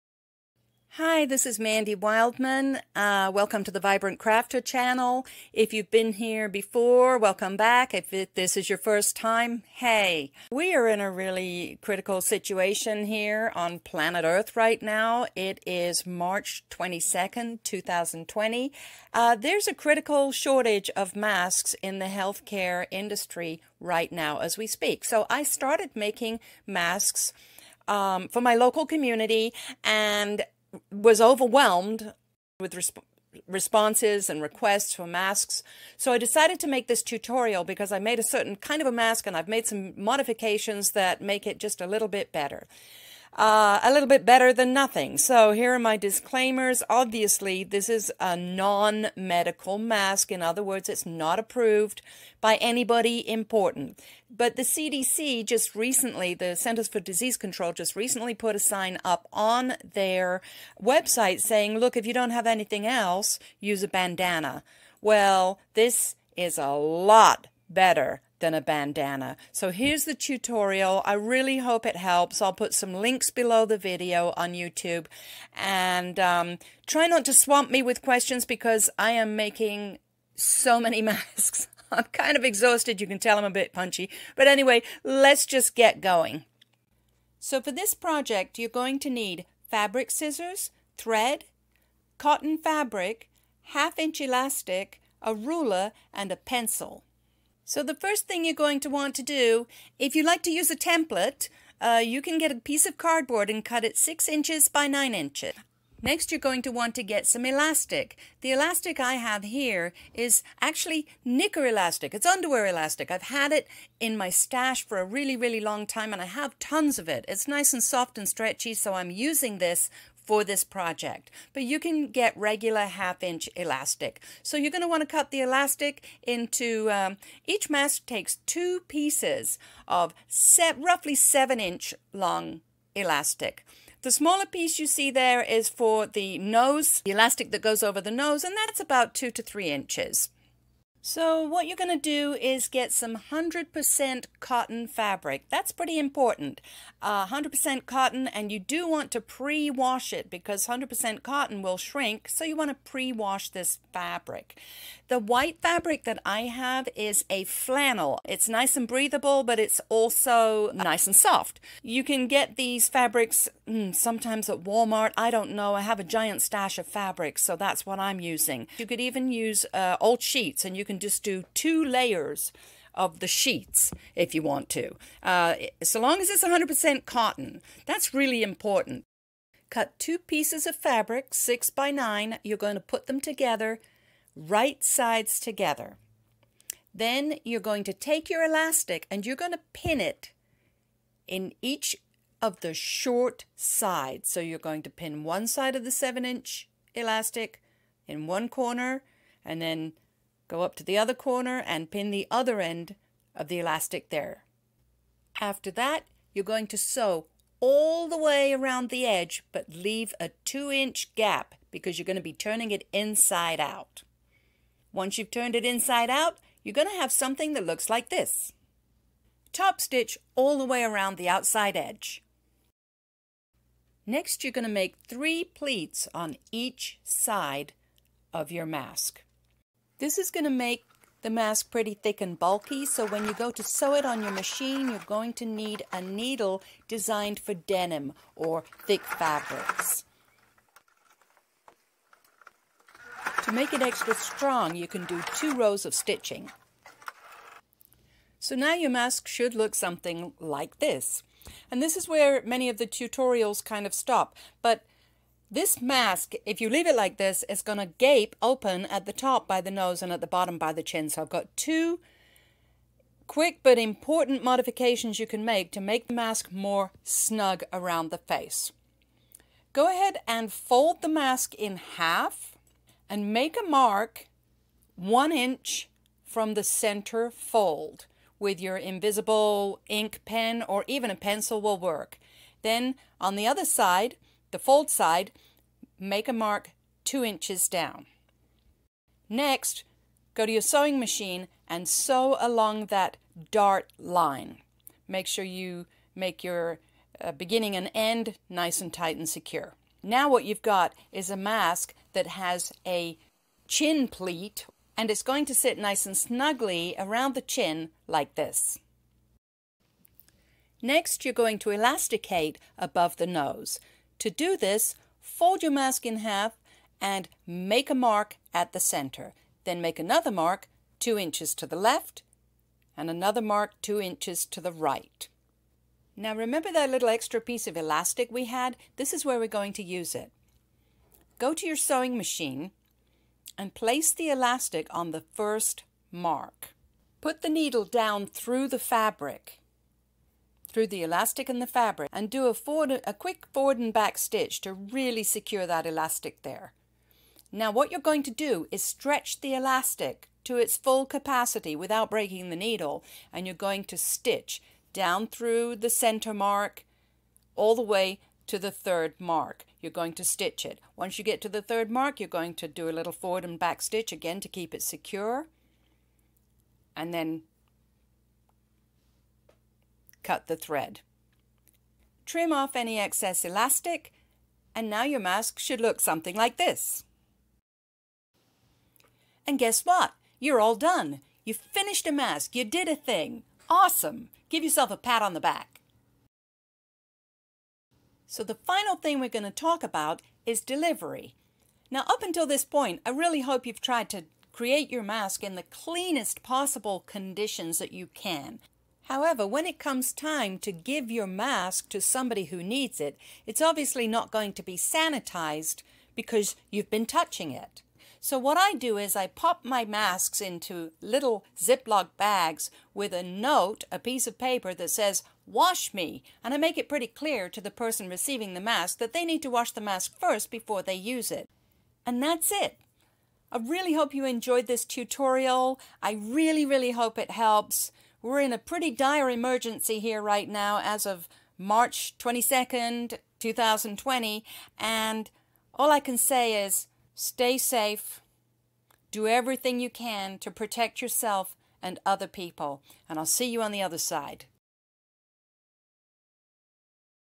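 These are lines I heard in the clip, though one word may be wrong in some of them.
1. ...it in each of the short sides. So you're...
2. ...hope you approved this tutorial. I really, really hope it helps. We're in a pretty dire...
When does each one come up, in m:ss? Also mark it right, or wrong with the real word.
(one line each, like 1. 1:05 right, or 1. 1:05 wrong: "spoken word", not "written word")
1. 3:10 right
2. 7:03 wrong: "enjoyed", not "approved".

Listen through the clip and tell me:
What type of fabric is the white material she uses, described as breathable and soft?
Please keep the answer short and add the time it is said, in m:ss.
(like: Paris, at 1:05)
flannel, at 2:37.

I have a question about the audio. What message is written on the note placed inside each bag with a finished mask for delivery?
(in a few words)
wash me.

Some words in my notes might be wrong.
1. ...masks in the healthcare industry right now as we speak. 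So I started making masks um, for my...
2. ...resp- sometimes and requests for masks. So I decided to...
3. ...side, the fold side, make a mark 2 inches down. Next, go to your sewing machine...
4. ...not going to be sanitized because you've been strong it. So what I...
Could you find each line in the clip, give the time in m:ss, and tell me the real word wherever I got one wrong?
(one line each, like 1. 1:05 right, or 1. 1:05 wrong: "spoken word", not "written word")
1. 0:21 right
2. 0:32 wrong: "responses", not "sometimes"
3. 4:43 right
4. 6:44 wrong: "touching", not "strong".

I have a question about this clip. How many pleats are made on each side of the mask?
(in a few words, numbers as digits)
3.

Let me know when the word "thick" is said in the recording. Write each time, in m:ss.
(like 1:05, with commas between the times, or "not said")
3:51, 3:58.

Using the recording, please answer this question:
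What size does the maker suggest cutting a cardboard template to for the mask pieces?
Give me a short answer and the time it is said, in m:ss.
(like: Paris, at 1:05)
6 inches by 9 inches, at 1:43.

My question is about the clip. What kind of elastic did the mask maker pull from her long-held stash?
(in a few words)
knicker elastic.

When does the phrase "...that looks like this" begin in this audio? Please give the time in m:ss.
3:37.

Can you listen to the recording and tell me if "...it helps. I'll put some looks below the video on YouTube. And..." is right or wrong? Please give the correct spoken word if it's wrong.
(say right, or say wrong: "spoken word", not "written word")
wrong: "links", not "looks".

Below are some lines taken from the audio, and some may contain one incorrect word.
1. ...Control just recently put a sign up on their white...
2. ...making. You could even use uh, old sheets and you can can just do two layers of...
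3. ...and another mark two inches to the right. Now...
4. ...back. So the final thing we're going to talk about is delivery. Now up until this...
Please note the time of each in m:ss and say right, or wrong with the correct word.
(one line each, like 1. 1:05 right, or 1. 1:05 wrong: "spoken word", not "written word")
1. 0:57 wrong: "website", not "white"
2. 2:48 wrong: "using", not "making"
3. 5:22 right
4. 6:25 right.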